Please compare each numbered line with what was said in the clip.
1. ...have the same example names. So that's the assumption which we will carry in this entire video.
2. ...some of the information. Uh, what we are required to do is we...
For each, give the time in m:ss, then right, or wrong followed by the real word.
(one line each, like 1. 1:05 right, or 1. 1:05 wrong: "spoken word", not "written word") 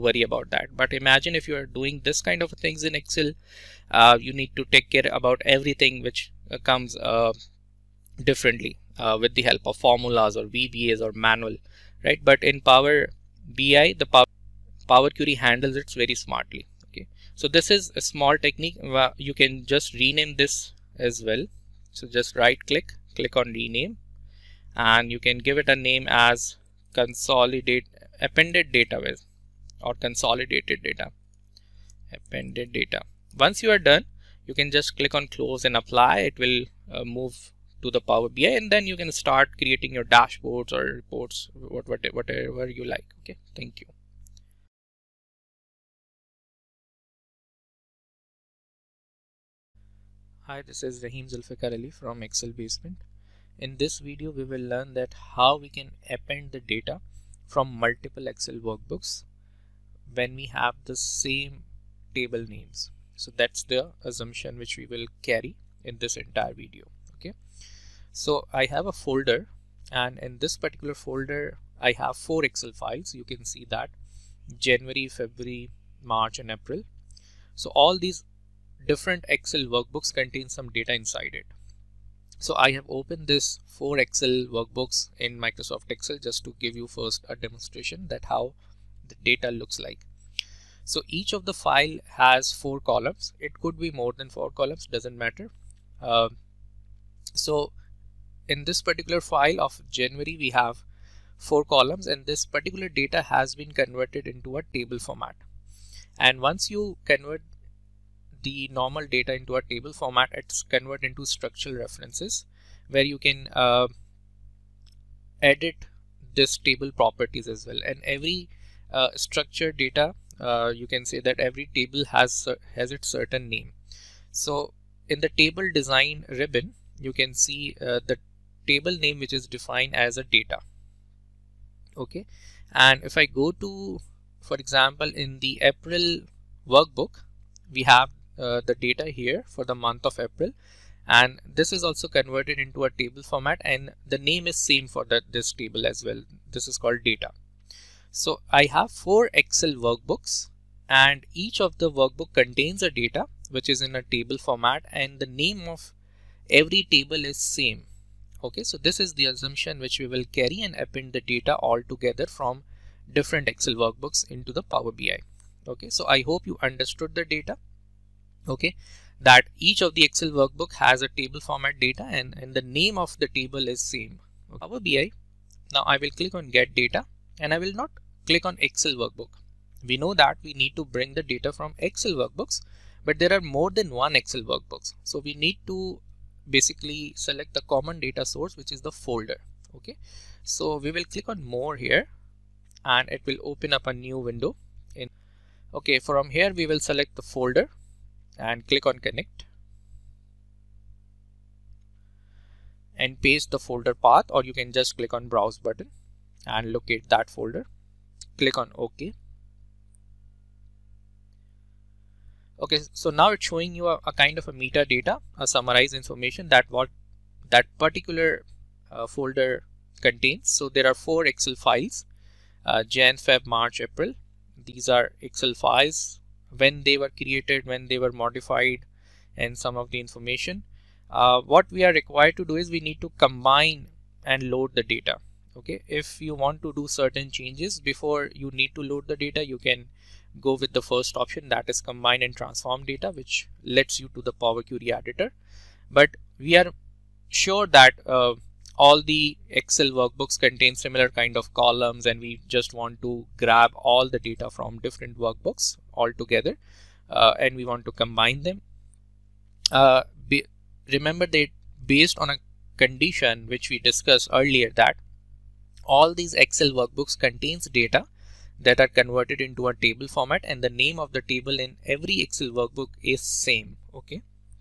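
1. 1:00 wrong: "table", not "example"
2. 3:49 right.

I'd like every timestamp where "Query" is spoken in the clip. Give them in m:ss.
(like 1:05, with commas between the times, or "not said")
0:15, 4:04.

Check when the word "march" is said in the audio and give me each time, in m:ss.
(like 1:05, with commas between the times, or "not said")
1:16, 3:43.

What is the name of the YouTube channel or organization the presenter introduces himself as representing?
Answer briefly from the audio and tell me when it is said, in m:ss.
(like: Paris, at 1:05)
Excel Basement, at 0:52.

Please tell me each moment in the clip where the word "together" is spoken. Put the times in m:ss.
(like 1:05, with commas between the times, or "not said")
2:41, 4:16.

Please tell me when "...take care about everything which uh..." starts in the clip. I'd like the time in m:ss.
0:04.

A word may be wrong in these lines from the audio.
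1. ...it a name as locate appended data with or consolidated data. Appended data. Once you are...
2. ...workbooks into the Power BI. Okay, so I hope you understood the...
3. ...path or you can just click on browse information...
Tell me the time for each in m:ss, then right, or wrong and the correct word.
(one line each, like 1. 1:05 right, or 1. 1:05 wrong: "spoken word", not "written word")
1. 0:25 wrong: "consolidate", not "locate"
2. 2:43 right
3. 3:23 wrong: "button", not "information".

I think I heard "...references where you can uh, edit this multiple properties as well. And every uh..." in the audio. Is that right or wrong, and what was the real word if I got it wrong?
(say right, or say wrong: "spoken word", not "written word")
wrong: "table", not "multiple".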